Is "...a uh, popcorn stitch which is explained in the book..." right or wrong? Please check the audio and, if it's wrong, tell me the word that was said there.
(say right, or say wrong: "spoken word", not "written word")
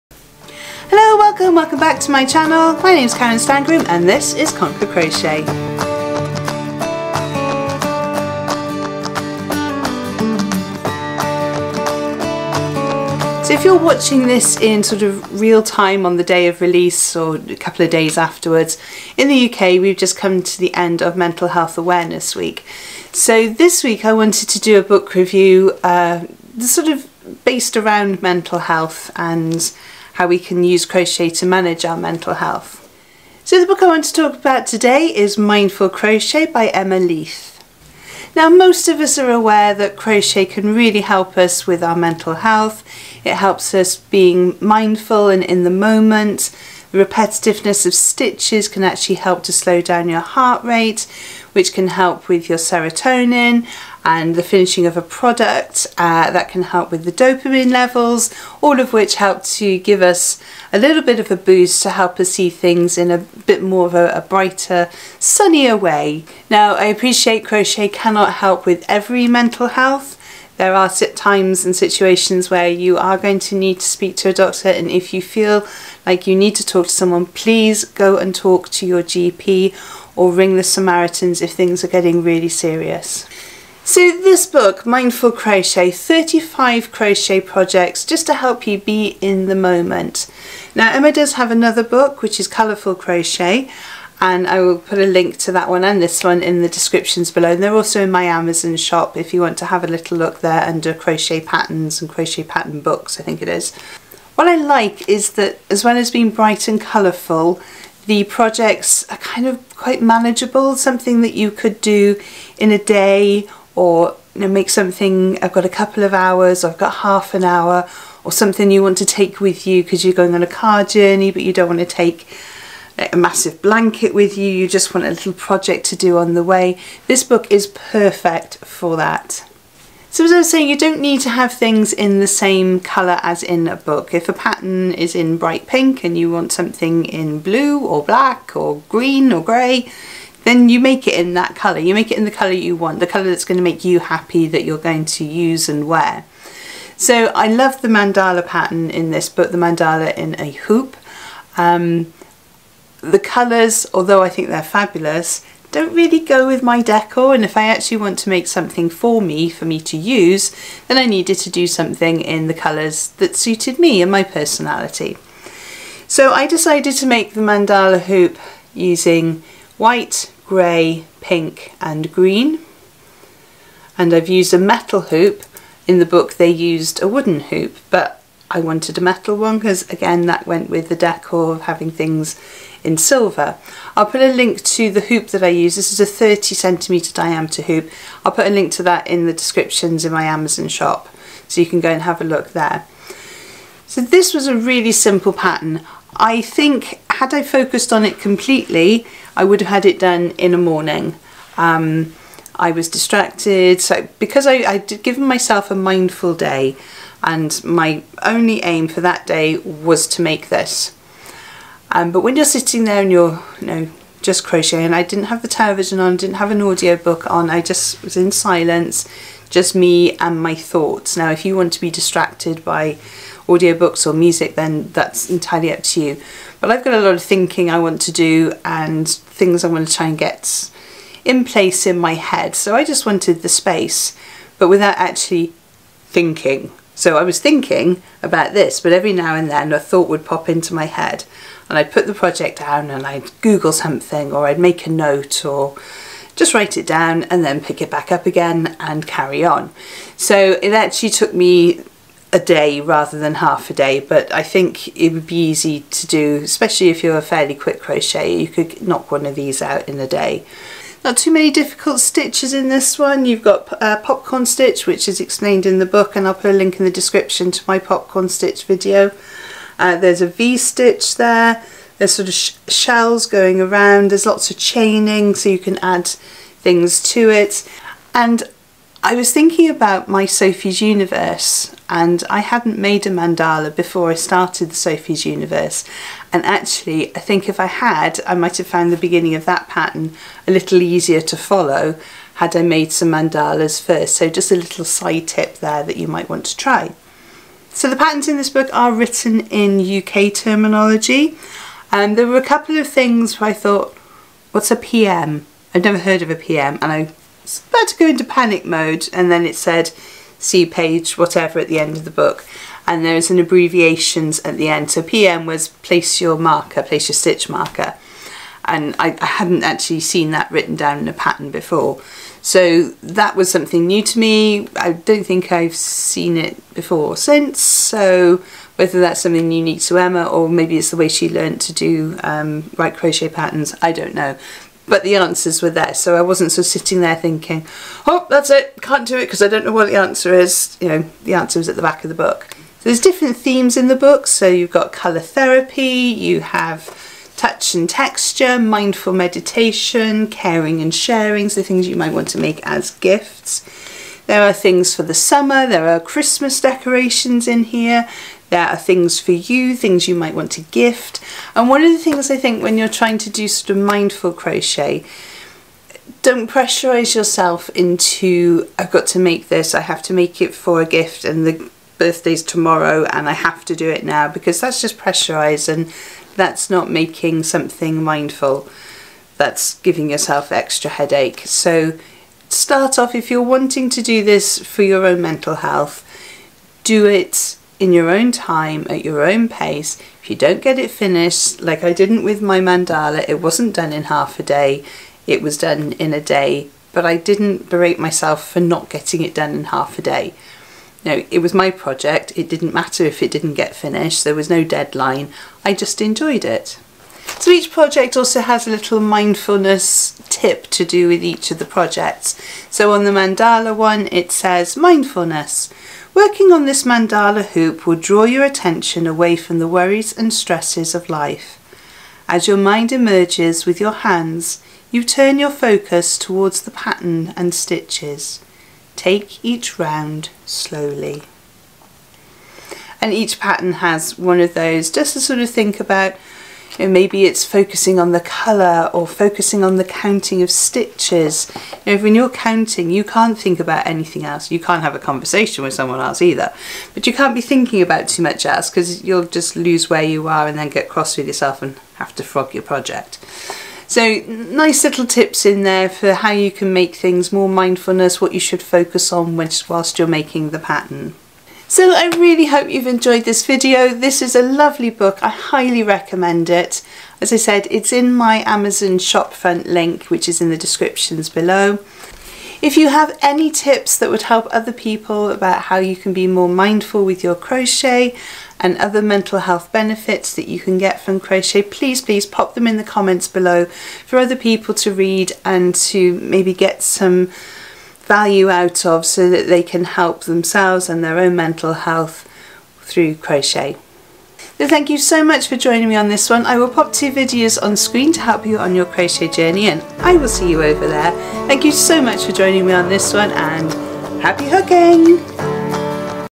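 right.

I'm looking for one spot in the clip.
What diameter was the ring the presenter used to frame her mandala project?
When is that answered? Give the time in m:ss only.
3:06.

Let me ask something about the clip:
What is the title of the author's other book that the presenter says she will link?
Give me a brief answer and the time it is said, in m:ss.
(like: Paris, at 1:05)
Colourful Crochet, at 1:32.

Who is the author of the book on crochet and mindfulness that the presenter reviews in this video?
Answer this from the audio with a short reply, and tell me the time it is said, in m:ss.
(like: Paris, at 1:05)
Emma Leith, at 0:36.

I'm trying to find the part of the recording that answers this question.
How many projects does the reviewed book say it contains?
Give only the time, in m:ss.
1:25.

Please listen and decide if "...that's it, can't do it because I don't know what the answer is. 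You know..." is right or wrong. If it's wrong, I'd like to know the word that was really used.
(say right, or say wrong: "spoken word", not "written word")
right.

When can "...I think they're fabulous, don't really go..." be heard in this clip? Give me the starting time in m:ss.
2:34.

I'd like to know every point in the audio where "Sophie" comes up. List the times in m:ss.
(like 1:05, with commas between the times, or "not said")
4:40, 4:44.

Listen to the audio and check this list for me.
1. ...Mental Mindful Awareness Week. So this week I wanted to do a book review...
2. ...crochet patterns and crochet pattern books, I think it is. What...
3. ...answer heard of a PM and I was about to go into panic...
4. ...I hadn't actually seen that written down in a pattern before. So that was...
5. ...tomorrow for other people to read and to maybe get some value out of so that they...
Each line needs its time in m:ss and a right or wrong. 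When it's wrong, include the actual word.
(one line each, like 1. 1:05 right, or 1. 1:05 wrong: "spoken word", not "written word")
1. 0:21 wrong: "Health", not "Mindful"
2. 1:40 right
3. 5:05 wrong: "never", not "answer"
4. 5:19 right
5. 8:03 wrong: "below", not "tomorrow".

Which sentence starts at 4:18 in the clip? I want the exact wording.
you could knock one of these out in a day.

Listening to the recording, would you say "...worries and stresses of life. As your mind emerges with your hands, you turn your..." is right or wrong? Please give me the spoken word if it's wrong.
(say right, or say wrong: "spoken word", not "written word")
right.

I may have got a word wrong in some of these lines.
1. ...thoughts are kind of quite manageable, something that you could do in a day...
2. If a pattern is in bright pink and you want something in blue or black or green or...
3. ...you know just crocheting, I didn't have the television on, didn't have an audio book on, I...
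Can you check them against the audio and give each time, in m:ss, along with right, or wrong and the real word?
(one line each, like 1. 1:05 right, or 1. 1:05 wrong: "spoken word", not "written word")
1. 1:48 wrong: "projects", not "thoughts"
2. 2:14 right
3. 3:33 right.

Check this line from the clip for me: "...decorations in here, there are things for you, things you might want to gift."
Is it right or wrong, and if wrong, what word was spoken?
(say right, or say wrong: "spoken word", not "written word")
right.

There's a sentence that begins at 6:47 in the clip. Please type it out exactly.
So each project also has a little mindfulness tip to do with each of the projects.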